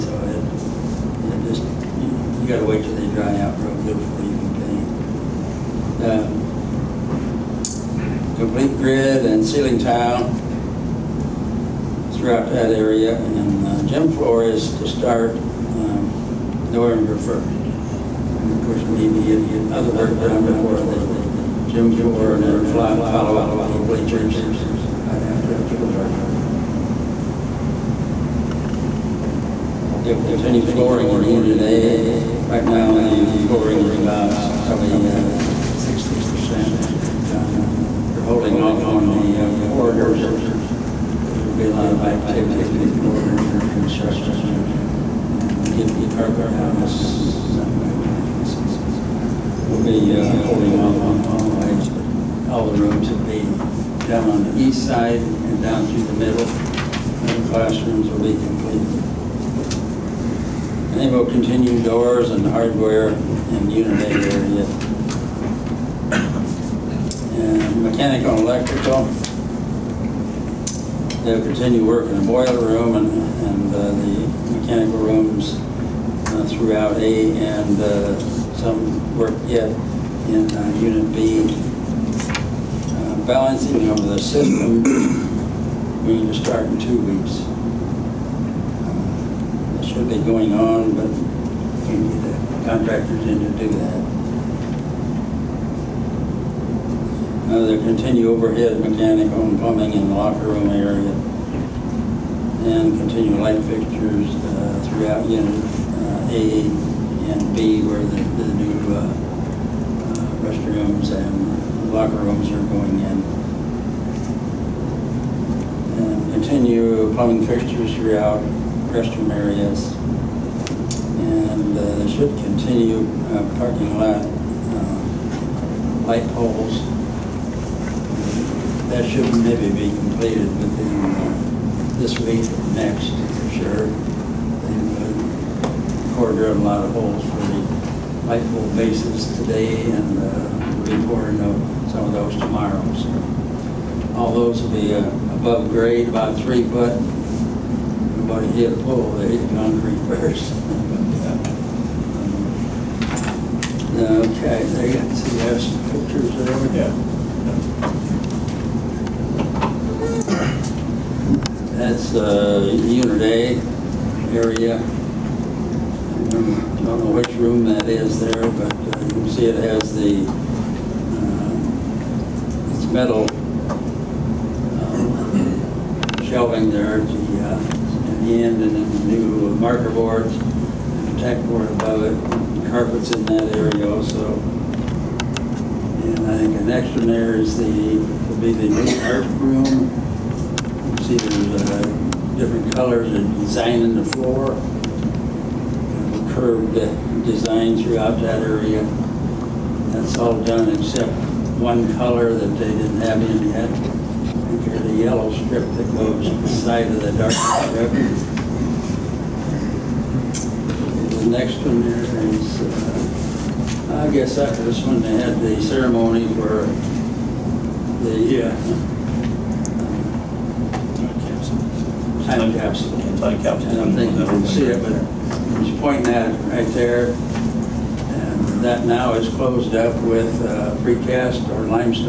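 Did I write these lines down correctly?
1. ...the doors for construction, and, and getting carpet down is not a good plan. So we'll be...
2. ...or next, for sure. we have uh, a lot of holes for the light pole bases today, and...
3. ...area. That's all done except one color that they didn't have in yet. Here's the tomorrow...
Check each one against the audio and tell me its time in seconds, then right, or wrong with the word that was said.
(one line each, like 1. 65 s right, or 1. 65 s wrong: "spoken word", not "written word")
1. 42 s wrong: "borders", not "doors"
2. 132 s right
3. 198 s wrong: "yellow", not "tomorrow".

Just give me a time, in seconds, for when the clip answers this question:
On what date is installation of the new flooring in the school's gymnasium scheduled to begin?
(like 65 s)
16 s.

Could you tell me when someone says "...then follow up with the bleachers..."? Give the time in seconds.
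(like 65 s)
22 s.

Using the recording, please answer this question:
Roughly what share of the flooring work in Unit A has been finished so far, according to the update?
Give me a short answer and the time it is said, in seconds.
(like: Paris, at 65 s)
60%, at 35 s.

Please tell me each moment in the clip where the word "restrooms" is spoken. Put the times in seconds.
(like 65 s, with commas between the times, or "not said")
110 s, 118 s.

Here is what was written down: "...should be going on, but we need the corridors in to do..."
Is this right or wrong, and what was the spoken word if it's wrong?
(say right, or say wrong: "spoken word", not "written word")
wrong: "contractors", not "corridors".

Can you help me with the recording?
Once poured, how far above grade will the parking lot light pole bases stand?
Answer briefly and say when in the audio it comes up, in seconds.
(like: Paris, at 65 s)
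three foot, at 146 s.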